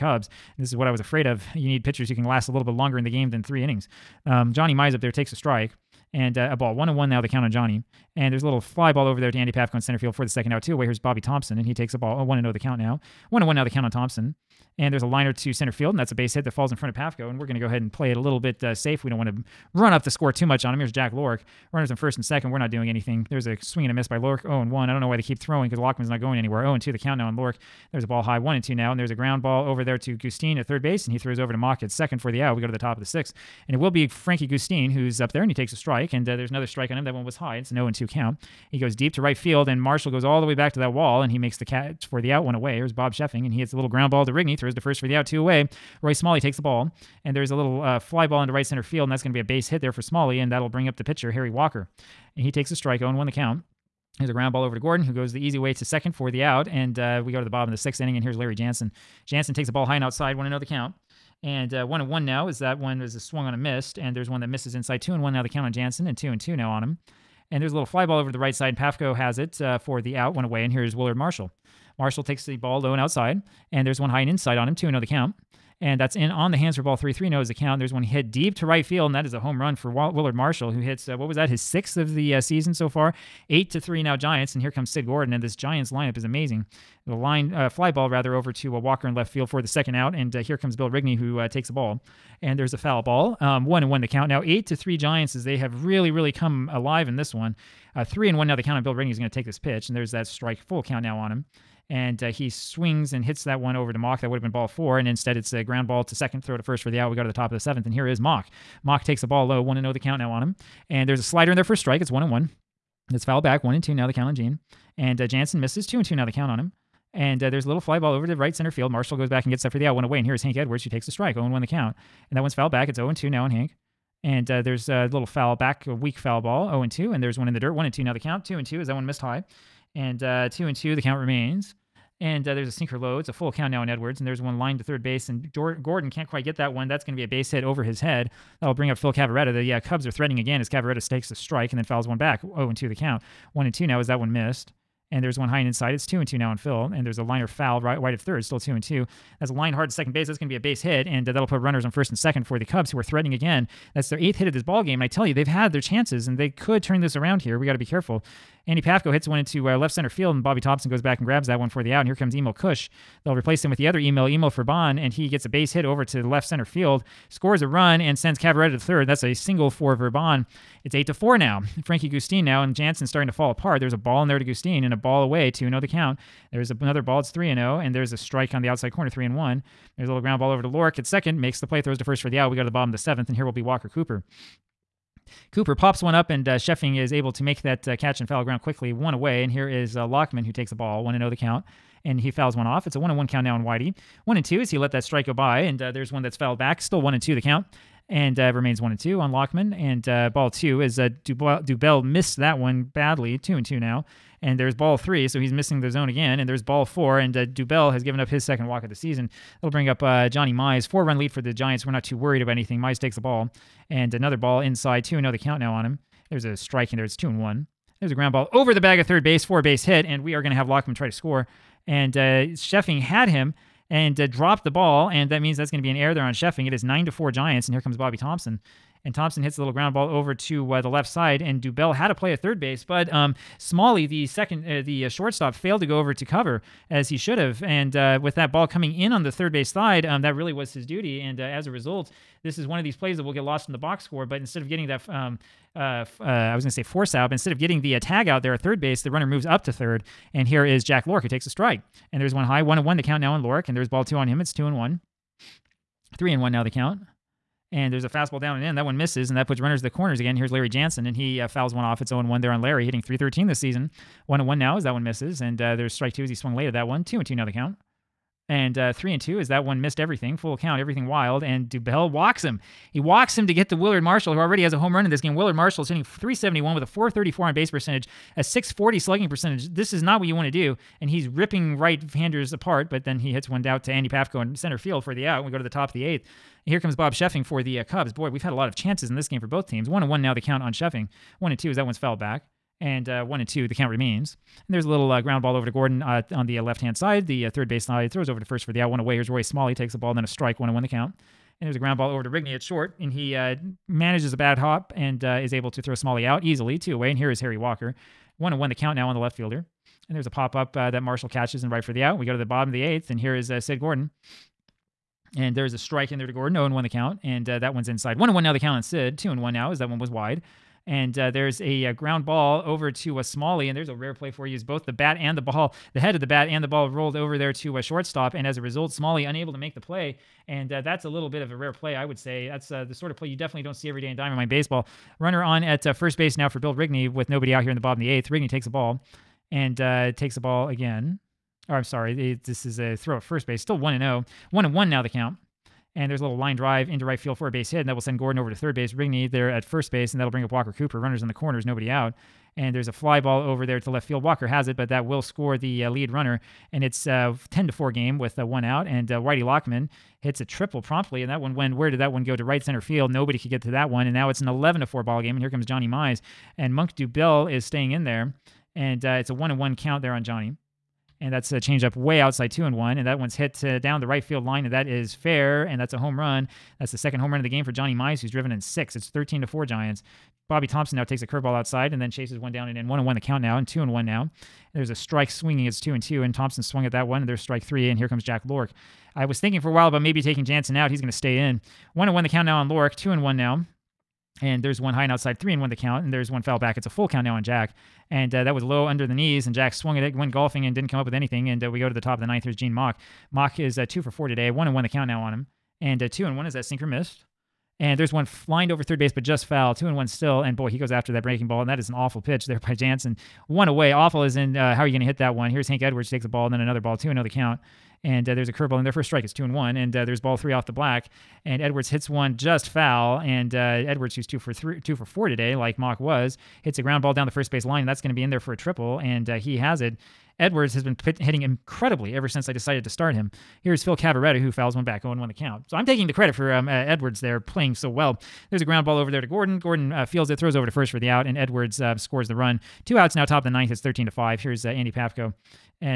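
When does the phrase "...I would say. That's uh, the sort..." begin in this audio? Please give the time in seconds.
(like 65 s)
331 s.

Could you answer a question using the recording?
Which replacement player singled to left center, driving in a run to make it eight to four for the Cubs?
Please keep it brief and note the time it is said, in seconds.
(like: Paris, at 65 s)
Verban, at 169 s.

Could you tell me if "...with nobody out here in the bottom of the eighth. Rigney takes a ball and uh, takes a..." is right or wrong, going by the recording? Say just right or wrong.
right.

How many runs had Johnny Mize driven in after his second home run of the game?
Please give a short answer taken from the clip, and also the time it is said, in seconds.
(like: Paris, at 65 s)
6, at 378 s.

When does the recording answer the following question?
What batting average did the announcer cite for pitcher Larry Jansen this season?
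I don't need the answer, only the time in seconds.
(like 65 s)
262 s.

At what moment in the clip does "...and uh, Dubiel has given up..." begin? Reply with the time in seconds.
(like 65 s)
207 s.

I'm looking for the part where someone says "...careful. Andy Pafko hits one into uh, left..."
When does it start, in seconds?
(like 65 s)
157 s.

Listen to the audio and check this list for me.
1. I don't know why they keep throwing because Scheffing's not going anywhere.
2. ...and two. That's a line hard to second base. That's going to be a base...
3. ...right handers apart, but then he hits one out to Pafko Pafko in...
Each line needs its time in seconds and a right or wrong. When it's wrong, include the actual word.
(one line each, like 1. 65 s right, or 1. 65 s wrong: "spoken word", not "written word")
1. 24 s wrong: "Lockman", not "Scheffing"
2. 148 s right
3. 281 s wrong: "Andy", not "Pafko".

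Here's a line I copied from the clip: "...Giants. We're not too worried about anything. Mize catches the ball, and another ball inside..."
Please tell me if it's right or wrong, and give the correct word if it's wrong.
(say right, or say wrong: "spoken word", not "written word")
wrong: "takes", not "catches".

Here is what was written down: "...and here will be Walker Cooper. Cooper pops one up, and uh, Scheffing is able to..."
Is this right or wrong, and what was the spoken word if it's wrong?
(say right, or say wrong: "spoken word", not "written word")
right.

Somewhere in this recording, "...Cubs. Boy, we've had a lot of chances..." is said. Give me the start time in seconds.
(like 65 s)
287 s.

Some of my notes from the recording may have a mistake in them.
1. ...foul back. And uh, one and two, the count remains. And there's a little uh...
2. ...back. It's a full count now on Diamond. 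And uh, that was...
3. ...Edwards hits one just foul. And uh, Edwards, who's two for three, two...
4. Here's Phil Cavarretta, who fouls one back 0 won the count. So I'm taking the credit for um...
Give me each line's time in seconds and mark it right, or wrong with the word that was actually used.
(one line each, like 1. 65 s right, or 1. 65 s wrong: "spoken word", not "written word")
1. 291 s right
2. 396 s wrong: "Jack", not "Diamond"
3. 421 s right
4. 433 s right.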